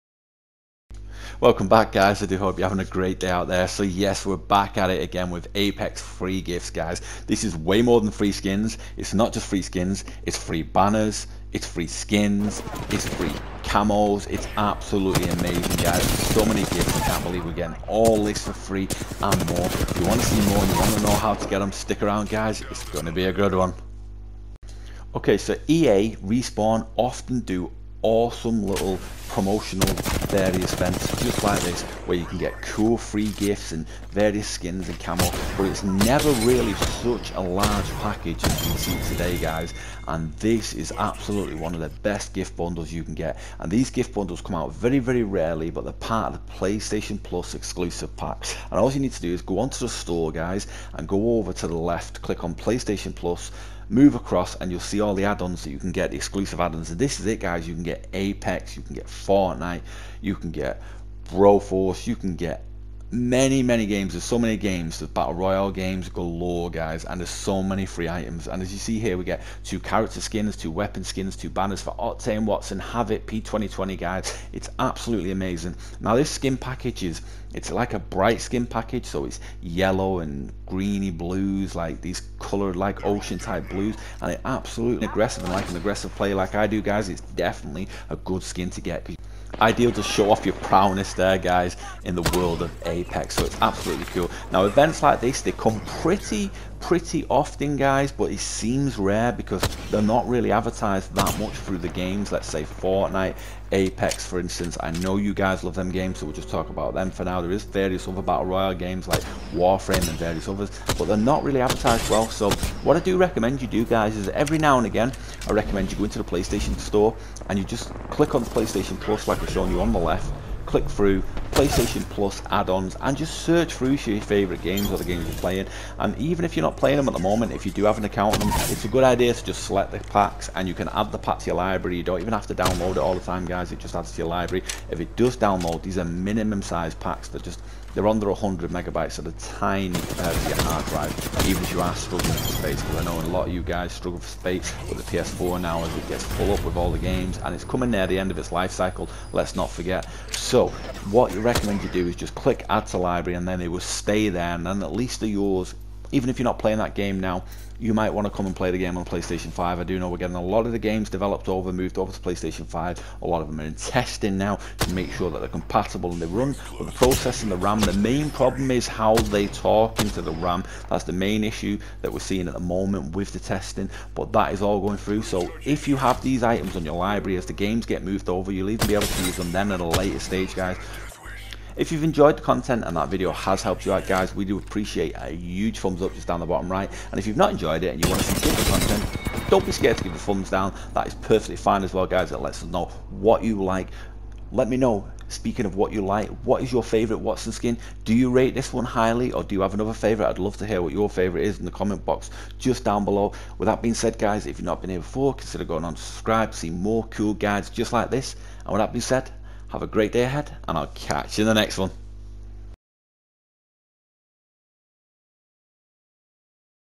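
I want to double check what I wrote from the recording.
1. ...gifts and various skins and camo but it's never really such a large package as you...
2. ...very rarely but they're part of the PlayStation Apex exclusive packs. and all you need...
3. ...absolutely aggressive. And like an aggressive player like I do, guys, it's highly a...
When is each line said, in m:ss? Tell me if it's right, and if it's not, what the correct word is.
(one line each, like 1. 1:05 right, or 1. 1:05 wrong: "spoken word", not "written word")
1. 0:33 right
2. 0:44 wrong: "Plus", not "Apex"
3. 1:24 wrong: "definitely", not "highly".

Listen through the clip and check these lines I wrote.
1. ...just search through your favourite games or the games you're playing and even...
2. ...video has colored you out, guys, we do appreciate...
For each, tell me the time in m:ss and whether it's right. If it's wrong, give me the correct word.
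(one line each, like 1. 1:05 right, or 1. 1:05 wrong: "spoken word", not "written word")
1. 2:03 right
2. 3:03 wrong: "helped", not "colored".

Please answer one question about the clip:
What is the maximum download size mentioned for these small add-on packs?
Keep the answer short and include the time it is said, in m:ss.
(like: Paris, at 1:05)
100 megabytes, at 2:18.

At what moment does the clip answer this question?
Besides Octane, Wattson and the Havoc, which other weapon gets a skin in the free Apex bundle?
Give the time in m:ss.
1:13.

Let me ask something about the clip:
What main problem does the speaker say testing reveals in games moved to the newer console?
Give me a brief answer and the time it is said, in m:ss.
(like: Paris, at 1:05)
how they talk into the RAM, at 2:48.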